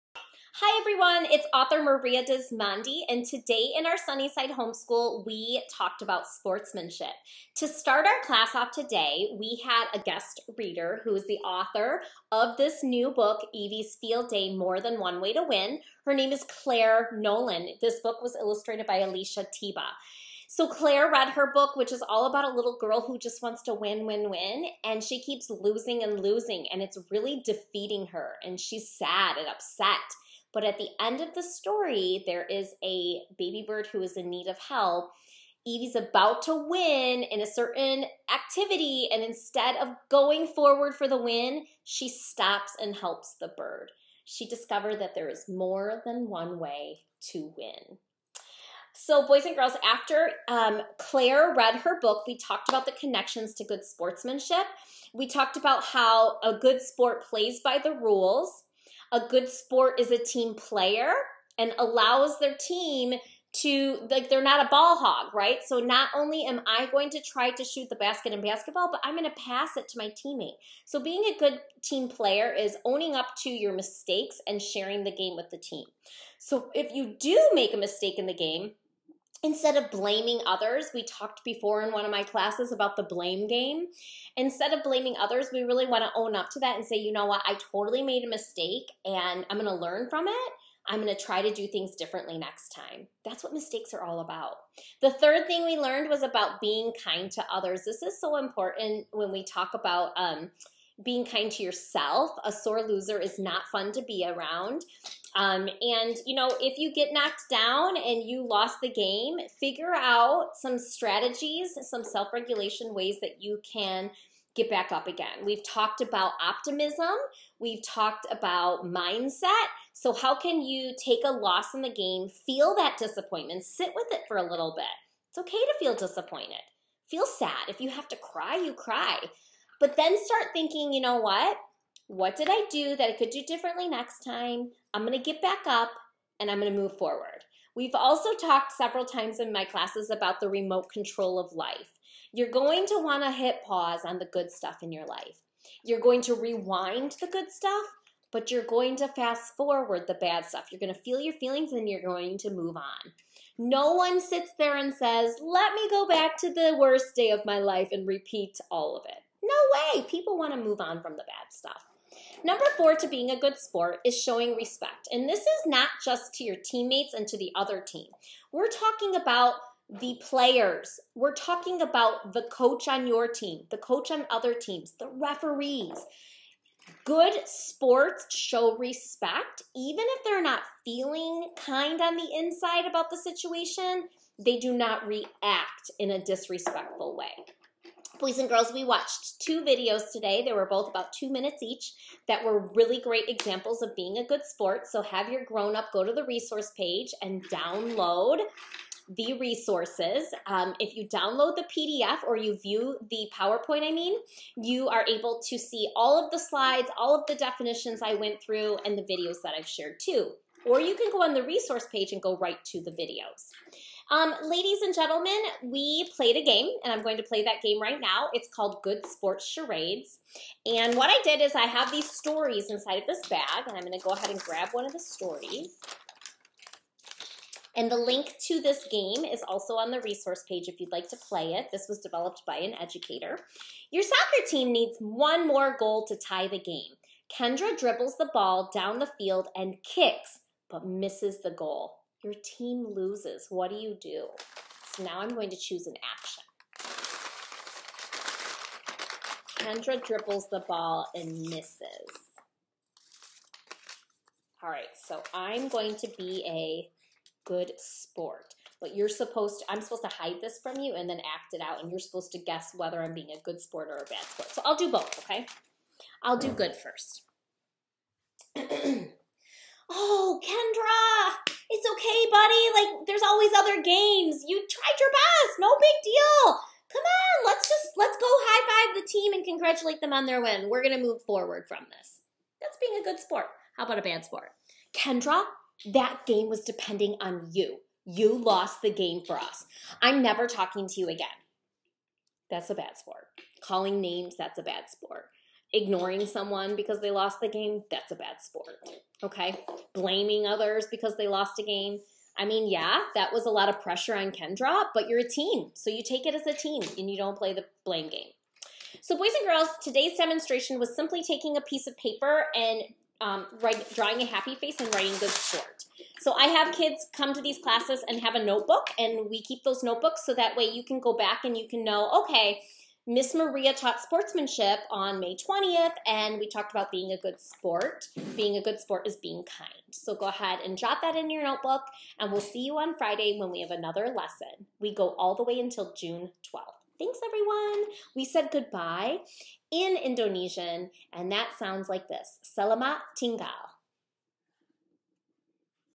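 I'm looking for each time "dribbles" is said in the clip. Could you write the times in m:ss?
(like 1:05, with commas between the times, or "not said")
3:57, 4:10.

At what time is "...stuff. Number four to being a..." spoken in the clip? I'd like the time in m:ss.
2:41.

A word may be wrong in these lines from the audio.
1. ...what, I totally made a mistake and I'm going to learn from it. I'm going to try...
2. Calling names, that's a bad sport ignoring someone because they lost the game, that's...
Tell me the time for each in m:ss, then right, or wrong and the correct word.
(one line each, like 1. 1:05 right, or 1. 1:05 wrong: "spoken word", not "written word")
1. 1:27 right
2. 4:53 right.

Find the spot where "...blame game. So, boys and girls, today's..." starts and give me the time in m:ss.
5:07.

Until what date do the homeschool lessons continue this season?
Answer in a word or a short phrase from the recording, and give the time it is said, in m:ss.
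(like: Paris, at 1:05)
June 12, at 5:35.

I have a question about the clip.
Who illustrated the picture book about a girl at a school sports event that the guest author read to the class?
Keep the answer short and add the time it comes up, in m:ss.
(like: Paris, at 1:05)
Alicia Teba, at 0:18.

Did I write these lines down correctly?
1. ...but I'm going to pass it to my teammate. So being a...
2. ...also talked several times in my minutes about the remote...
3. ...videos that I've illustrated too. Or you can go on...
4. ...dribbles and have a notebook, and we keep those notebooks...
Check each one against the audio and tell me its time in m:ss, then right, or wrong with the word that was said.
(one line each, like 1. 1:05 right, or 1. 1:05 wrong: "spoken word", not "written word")
1. 1:08 right
2. 2:17 wrong: "classes", not "minutes"
3. 3:29 wrong: "shared", not "illustrated"
4. 5:17 wrong: "classes", not "dribbles".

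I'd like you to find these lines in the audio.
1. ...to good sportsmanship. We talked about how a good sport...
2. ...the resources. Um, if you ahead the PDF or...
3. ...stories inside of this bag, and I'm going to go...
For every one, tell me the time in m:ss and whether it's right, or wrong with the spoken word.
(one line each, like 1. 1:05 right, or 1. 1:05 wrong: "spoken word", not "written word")
1. 0:53 right
2. 3:19 wrong: "download", not "ahead"
3. 3:42 right.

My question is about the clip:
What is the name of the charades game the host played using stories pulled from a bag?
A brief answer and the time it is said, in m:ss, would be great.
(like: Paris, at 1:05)
Good Sports Charades, at 3:38.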